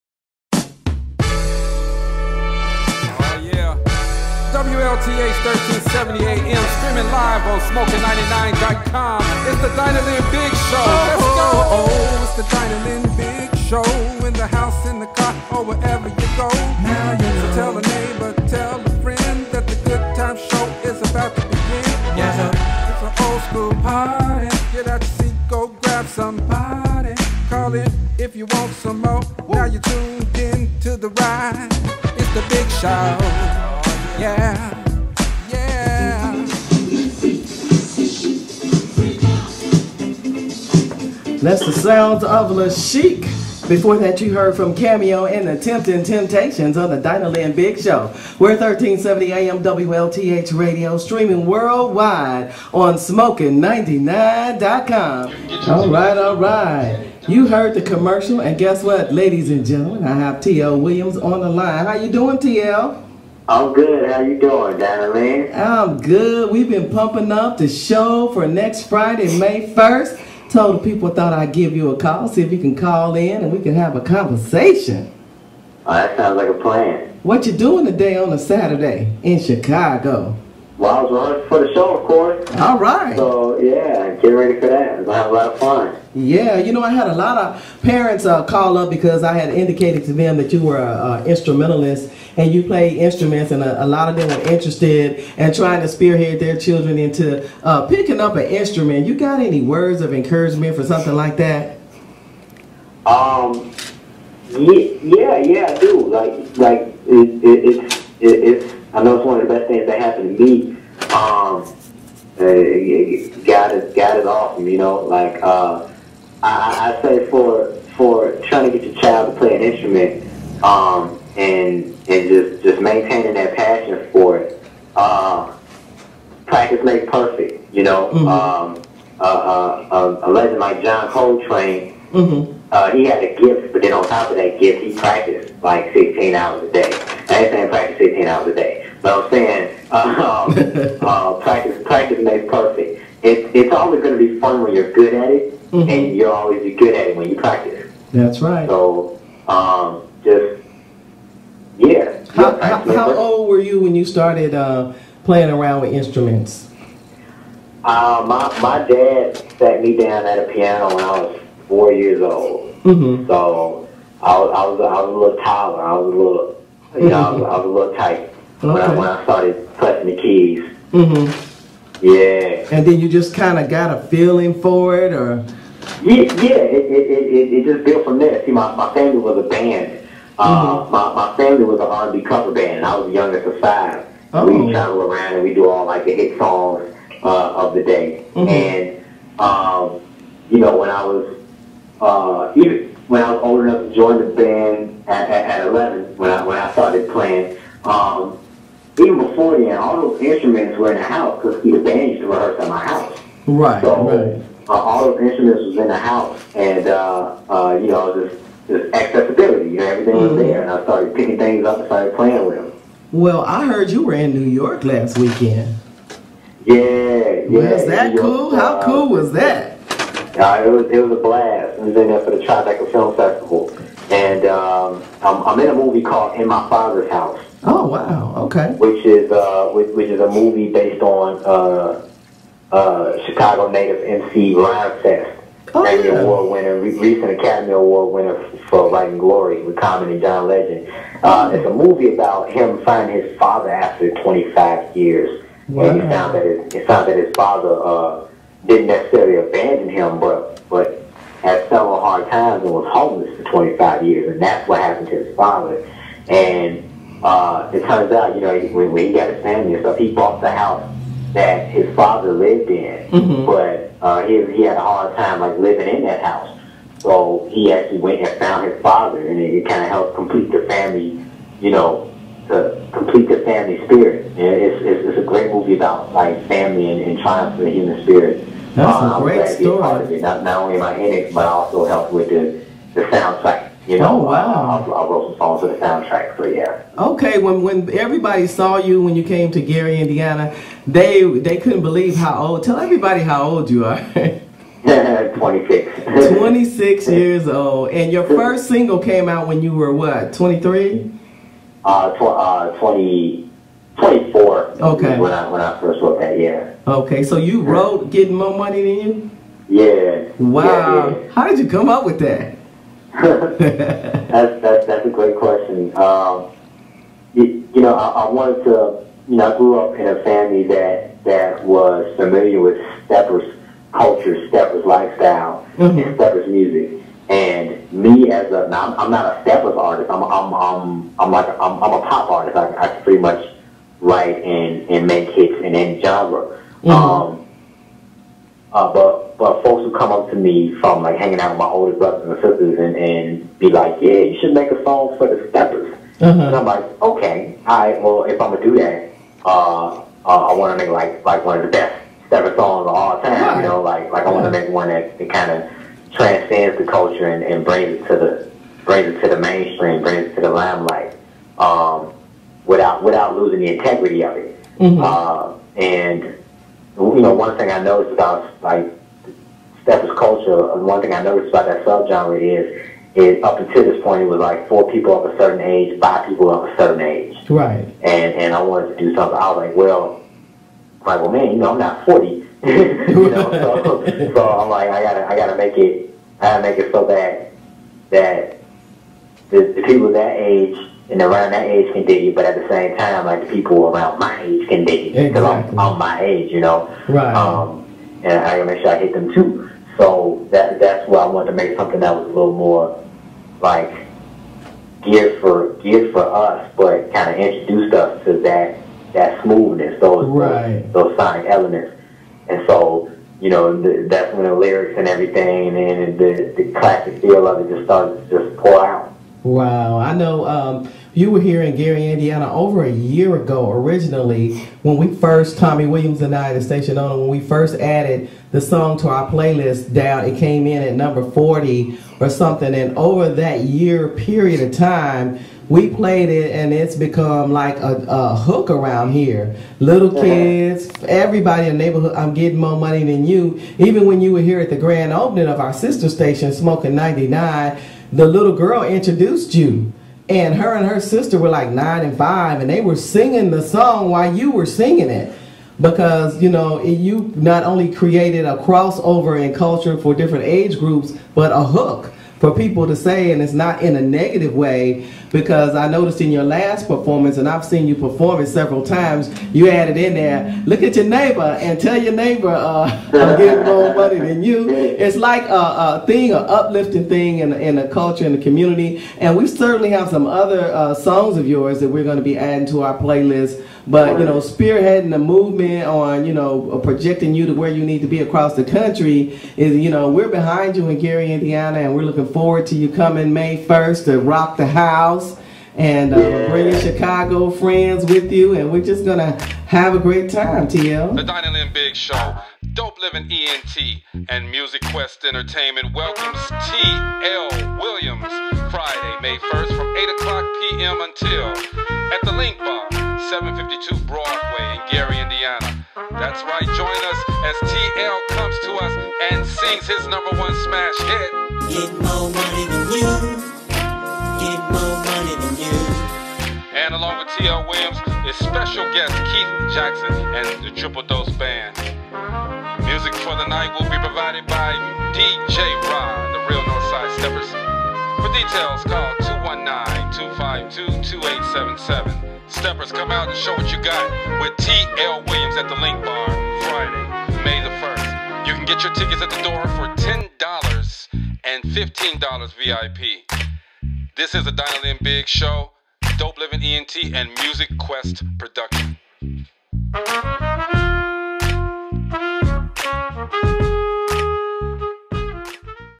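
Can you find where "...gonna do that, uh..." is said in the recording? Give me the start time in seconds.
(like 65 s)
348 s.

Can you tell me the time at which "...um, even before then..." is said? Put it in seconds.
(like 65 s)
197 s.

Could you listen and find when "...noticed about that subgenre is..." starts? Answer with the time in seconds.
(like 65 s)
371 s.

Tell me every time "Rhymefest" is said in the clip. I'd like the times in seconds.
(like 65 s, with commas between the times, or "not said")
234 s.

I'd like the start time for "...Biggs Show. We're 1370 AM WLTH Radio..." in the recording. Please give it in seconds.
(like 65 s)
47 s.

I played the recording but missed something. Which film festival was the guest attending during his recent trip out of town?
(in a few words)
Tribeca Film Festival.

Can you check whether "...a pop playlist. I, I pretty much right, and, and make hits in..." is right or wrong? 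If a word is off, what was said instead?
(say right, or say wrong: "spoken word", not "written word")
wrong: "artist", not "playlist".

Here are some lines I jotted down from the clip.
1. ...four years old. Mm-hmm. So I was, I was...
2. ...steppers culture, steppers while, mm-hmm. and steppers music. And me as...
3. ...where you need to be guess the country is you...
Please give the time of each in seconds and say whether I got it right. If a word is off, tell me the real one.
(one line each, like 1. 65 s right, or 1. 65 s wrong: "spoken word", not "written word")
1. 161 s right
2. 323 s wrong: "lifestyle", not "while"
3. 487 s wrong: "across", not "guess".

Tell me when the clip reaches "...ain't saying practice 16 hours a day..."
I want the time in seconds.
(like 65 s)
137 s.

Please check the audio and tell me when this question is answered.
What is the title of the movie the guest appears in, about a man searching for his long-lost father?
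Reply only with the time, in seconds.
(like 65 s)
226 s.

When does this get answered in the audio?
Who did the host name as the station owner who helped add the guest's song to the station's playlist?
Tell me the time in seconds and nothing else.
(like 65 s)
425 s.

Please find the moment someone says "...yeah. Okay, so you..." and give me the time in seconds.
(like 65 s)
306 s.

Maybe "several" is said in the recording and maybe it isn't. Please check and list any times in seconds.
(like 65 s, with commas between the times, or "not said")
251 s, 468 s.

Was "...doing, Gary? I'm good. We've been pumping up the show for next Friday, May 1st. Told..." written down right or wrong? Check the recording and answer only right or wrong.
wrong.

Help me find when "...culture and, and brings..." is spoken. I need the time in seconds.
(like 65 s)
356 s.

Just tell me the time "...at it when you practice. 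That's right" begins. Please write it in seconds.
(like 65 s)
146 s.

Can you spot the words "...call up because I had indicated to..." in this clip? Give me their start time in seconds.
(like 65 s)
88 s.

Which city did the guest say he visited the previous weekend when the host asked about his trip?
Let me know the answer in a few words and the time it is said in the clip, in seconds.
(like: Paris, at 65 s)
New York, at 214 s.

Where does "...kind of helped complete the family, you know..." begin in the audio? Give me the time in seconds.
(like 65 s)
269 s.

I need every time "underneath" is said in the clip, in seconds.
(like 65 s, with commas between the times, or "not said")
not said.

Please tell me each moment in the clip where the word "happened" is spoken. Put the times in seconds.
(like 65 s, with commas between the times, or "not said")
110 s, 254 s.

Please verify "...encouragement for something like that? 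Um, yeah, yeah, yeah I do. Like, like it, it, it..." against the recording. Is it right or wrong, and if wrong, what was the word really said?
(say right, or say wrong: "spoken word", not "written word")
right.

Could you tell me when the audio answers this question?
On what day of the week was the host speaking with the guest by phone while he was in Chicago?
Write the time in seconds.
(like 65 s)
78 s.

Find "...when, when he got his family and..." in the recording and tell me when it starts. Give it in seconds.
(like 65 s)
258 s.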